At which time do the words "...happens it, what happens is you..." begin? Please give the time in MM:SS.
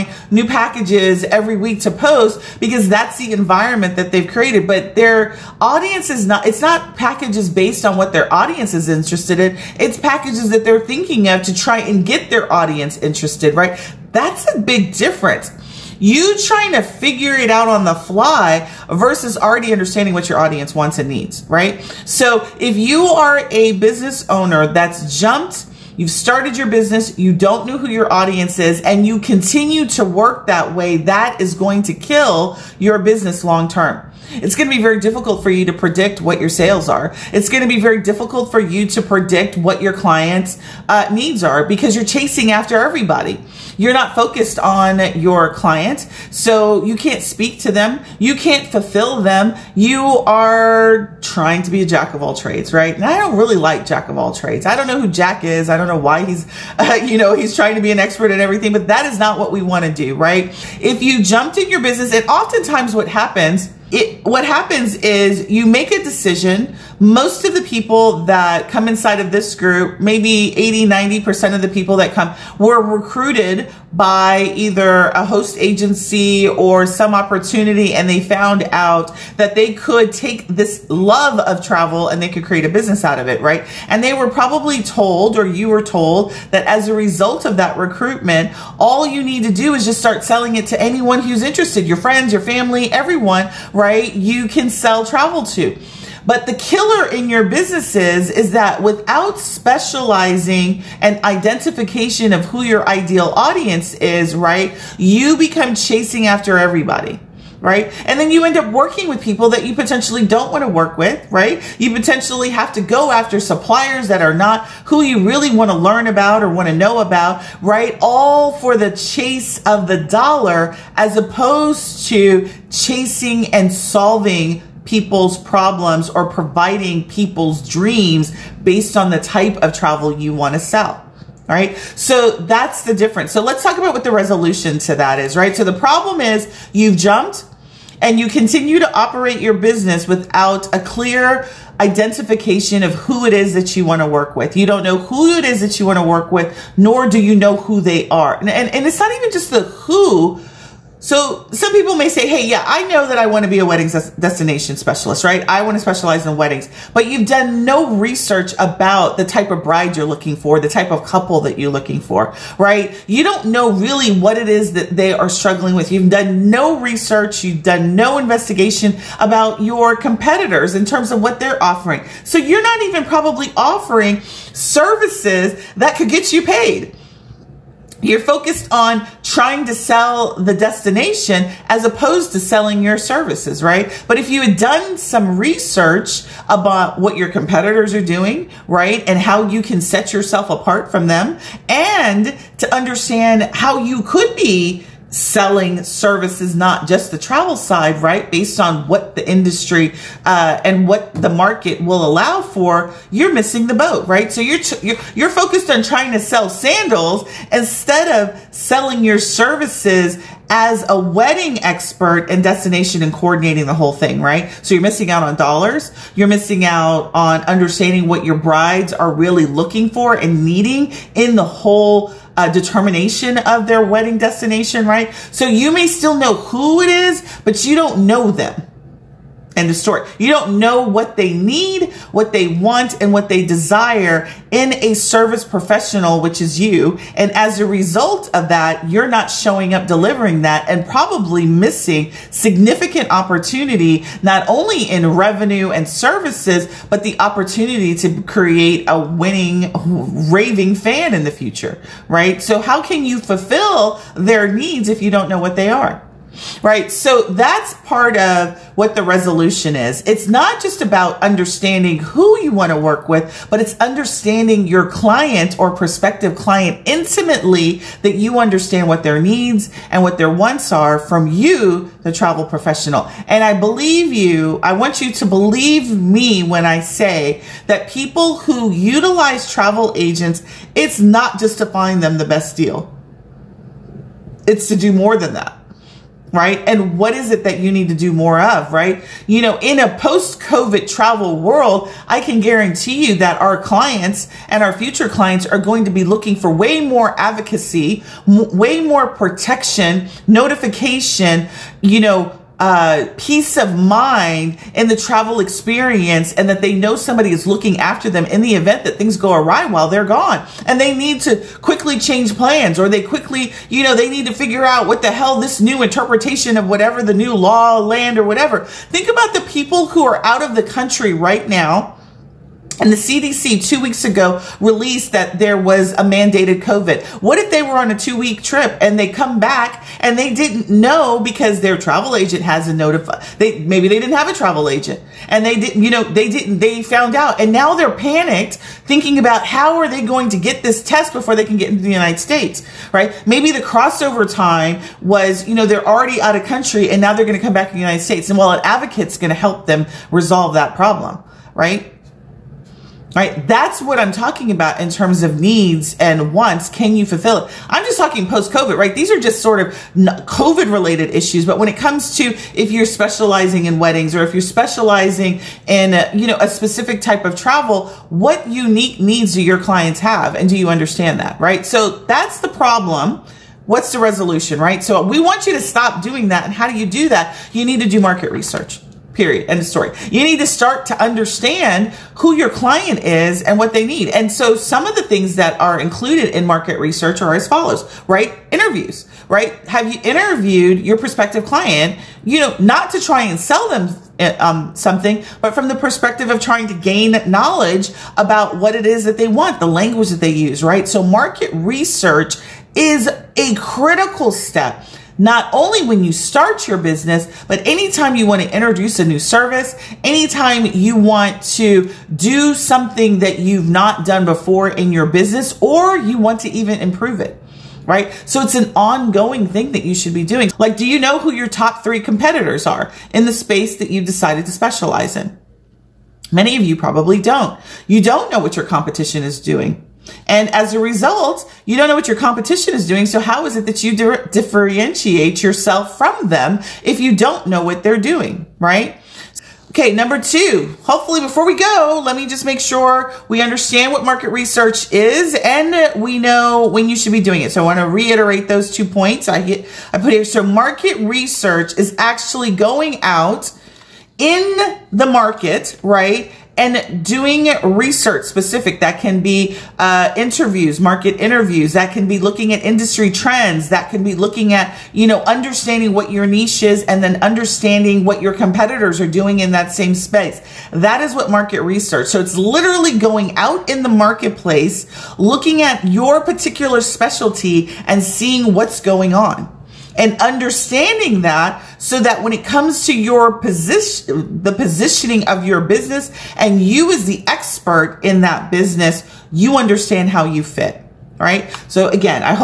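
01:03.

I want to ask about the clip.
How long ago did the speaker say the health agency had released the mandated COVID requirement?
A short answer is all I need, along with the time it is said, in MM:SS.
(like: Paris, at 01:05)
two weeks ago, at 05:23.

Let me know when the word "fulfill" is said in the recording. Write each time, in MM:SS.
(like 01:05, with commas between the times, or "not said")
00:48, 04:13, 05:57.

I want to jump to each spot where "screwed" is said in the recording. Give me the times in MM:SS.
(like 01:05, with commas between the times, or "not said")
not said.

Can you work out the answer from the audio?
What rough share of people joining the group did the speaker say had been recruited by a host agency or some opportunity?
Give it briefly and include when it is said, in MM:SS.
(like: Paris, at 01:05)
80, 90%, at 01:10.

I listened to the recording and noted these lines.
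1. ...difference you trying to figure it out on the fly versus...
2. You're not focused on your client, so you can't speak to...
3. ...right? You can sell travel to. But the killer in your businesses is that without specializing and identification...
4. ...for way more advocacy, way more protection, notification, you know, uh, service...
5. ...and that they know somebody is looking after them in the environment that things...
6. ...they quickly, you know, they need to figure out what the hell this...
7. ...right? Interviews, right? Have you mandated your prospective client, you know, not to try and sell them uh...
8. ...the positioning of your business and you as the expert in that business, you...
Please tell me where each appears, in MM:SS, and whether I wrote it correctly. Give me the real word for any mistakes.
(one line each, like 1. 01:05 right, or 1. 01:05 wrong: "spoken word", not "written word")
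1. 00:14 right
2. 00:43 right
3. 01:33 right
4. 04:56 wrong: "peace", not "service"
5. 05:06 wrong: "event", not "environment"
6. 05:12 right
7. 06:28 wrong: "interviewed", not "mandated"
8. 08:04 right.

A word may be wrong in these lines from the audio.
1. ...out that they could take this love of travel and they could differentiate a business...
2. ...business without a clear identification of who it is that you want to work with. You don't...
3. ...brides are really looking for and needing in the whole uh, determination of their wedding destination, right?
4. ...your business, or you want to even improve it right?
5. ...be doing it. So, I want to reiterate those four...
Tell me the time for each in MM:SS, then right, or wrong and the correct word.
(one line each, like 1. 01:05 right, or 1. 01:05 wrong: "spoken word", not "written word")
1. 01:18 wrong: "create", not "differentiate"
2. 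02:19 right
3. 03:38 right
4. 06:54 right
5. 07:27 wrong: "two", not "four".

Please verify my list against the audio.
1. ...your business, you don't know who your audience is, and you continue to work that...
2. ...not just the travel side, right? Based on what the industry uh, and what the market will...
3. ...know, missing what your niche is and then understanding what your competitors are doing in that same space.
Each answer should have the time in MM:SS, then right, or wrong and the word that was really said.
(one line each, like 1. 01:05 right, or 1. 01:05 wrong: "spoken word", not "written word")
1. 00:26 right
2. 03:16 right
3. 07:45 wrong: "understanding", not "missing".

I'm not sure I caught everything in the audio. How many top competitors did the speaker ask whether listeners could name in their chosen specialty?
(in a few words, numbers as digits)
3.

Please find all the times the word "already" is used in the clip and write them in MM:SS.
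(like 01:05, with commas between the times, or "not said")
00:19, 05:45.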